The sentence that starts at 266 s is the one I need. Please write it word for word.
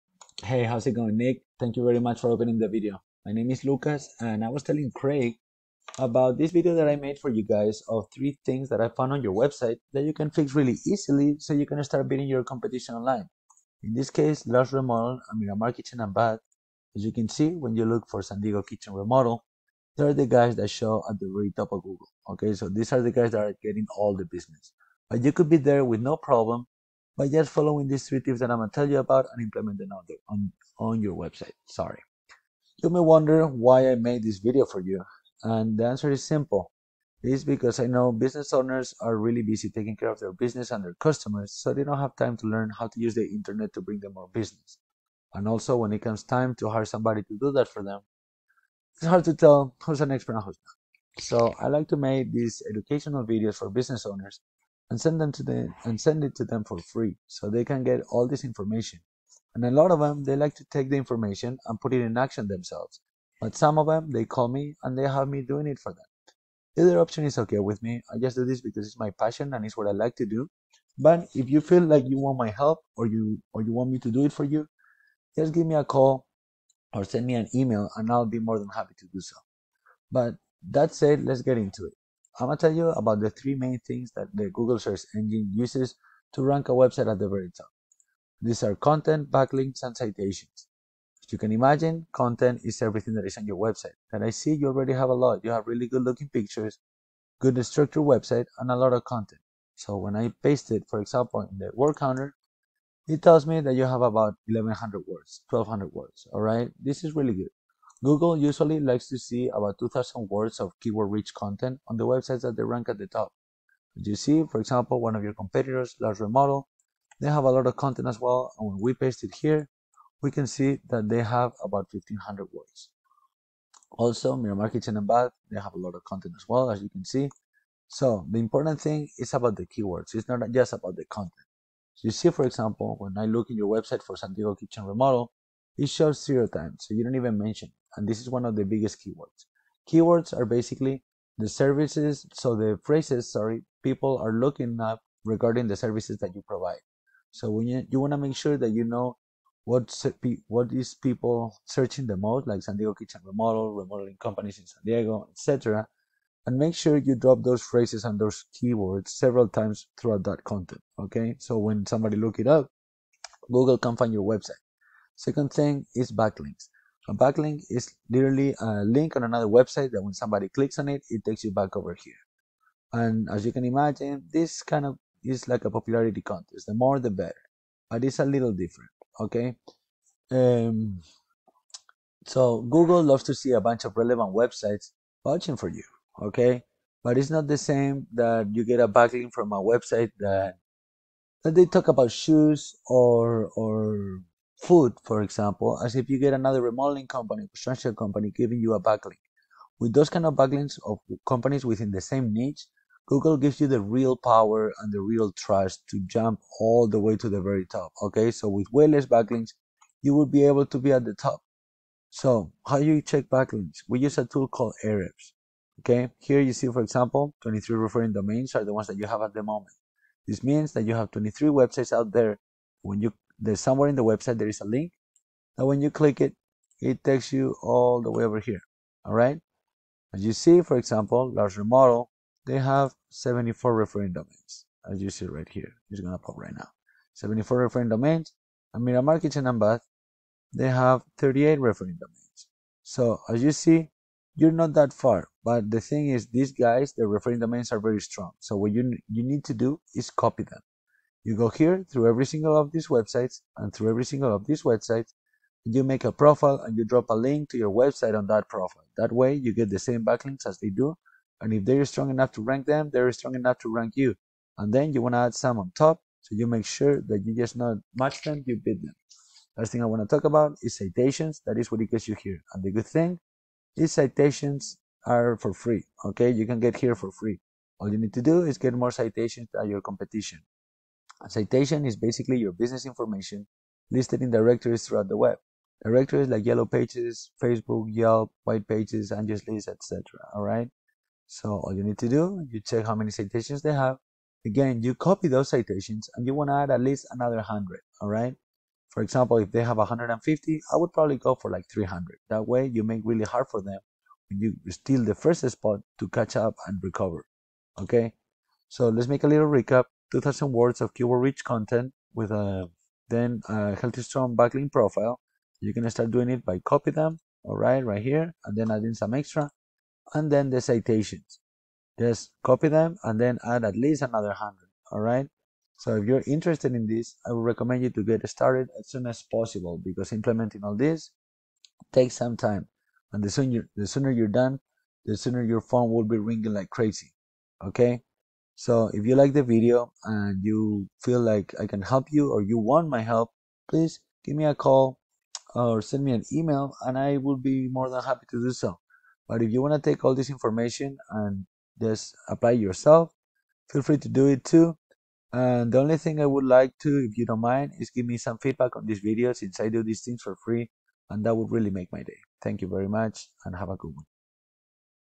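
So you make sure that you just not match them, you beat them.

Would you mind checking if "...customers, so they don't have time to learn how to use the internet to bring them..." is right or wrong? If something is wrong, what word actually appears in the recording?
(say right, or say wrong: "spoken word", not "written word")
right.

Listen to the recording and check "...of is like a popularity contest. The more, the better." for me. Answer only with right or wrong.
right.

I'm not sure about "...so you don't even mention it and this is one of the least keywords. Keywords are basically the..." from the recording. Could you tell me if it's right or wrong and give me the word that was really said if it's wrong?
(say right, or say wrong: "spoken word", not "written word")
wrong: "biggest", not "least".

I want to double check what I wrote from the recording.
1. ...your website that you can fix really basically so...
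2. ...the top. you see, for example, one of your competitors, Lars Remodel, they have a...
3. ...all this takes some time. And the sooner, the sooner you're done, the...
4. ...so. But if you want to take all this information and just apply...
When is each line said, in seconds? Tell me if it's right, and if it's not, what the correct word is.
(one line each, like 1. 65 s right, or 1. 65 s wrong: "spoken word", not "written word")
1. 9 s wrong: "easily", not "basically"
2. 112 s right
3. 330 s right
4. 348 s right.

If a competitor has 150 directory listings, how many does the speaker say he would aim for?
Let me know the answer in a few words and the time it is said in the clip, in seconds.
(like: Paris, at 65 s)
300, at 301 s.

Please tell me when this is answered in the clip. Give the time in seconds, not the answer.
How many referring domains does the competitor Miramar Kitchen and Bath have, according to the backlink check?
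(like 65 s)
241 s.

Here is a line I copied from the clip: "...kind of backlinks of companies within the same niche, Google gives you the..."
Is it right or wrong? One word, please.
right.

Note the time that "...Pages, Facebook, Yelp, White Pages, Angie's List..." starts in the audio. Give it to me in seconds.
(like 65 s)
286 s.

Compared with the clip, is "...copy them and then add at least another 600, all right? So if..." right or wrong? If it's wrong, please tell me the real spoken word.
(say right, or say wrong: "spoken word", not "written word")
wrong: "100", not "600".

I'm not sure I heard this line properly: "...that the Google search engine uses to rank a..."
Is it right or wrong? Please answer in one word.
right.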